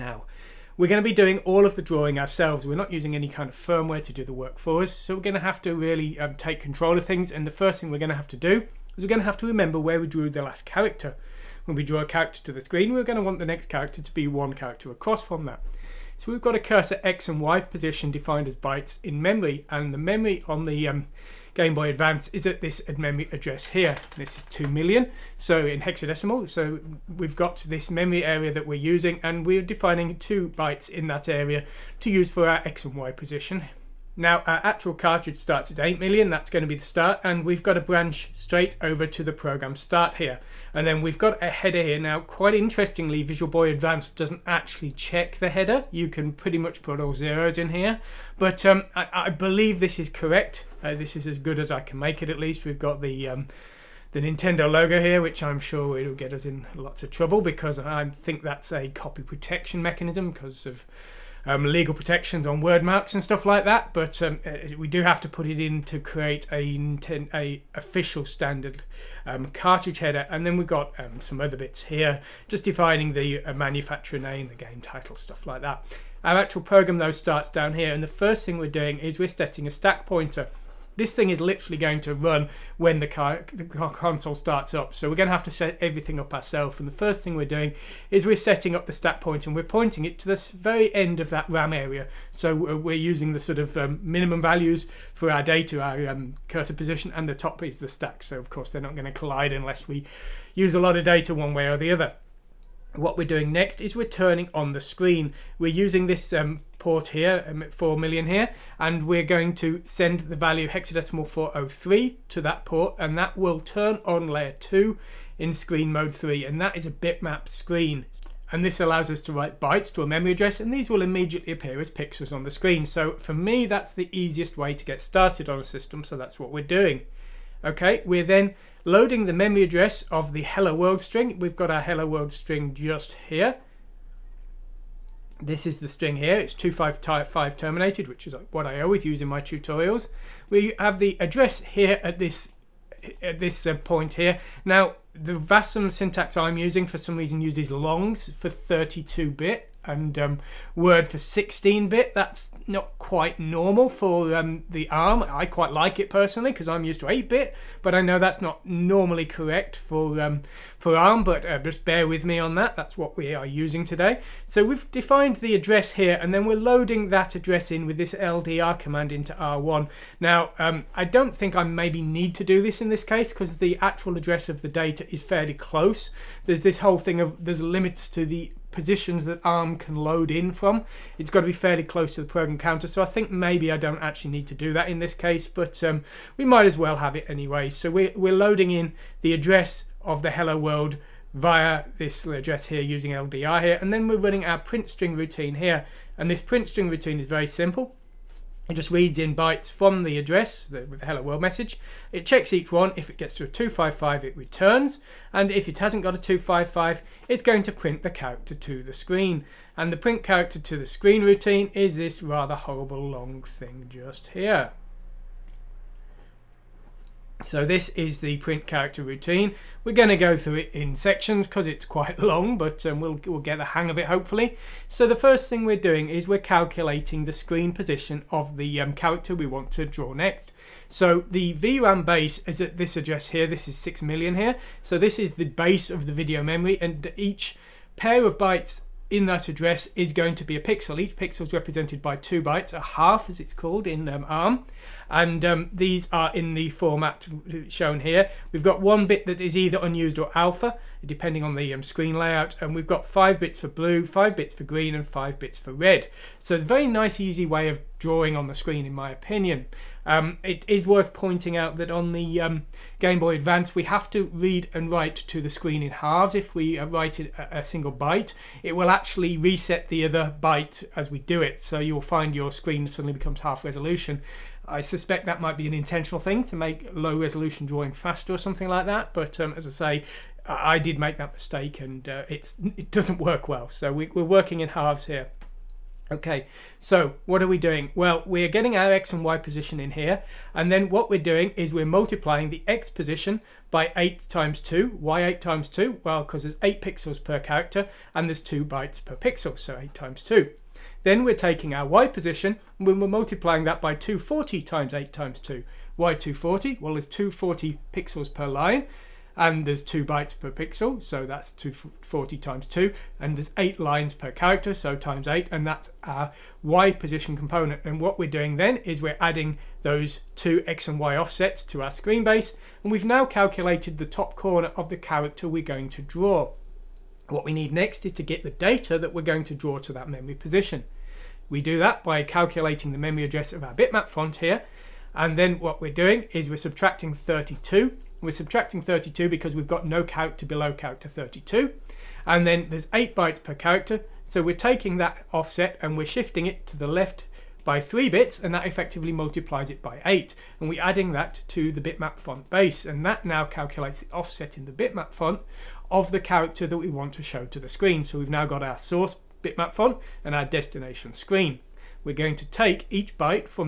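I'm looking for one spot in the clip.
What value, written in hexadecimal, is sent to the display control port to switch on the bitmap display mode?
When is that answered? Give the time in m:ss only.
1:50.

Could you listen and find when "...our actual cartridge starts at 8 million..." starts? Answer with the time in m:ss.
0:34.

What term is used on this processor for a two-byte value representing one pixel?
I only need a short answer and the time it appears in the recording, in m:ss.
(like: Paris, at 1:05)
a half, at 4:02.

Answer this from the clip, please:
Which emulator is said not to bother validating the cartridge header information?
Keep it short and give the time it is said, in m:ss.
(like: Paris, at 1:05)
Visual Boy Advance, at 0:43.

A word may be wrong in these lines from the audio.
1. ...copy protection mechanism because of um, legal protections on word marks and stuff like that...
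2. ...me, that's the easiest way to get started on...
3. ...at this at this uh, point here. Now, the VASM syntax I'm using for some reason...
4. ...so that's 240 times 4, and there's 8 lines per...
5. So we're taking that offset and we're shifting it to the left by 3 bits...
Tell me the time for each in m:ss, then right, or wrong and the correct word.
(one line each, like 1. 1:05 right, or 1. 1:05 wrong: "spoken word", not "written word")
1. 0:58 right
2. 2:03 right
3. 2:22 right
4. 5:11 wrong: "2", not "4"
5. 5:44 right.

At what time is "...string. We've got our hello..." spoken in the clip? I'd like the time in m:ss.
2:11.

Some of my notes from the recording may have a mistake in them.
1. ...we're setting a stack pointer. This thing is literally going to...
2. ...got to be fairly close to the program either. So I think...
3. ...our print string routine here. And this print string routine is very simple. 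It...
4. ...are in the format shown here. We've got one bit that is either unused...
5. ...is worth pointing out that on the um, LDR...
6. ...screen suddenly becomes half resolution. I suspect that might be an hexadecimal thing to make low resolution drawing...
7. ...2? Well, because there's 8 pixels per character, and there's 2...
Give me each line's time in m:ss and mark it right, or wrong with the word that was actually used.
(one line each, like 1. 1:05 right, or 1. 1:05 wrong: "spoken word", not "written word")
1. 1:19 right
2. 3:01 wrong: "counter", not "either"
3. 3:14 right
4. 4:06 right
5. 4:20 wrong: "Game", not "LDR"
6. 4:32 wrong: "intentional", not "hexadecimal"
7. 4:55 right.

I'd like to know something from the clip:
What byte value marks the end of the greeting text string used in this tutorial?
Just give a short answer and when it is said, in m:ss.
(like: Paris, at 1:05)
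255, at 2:16.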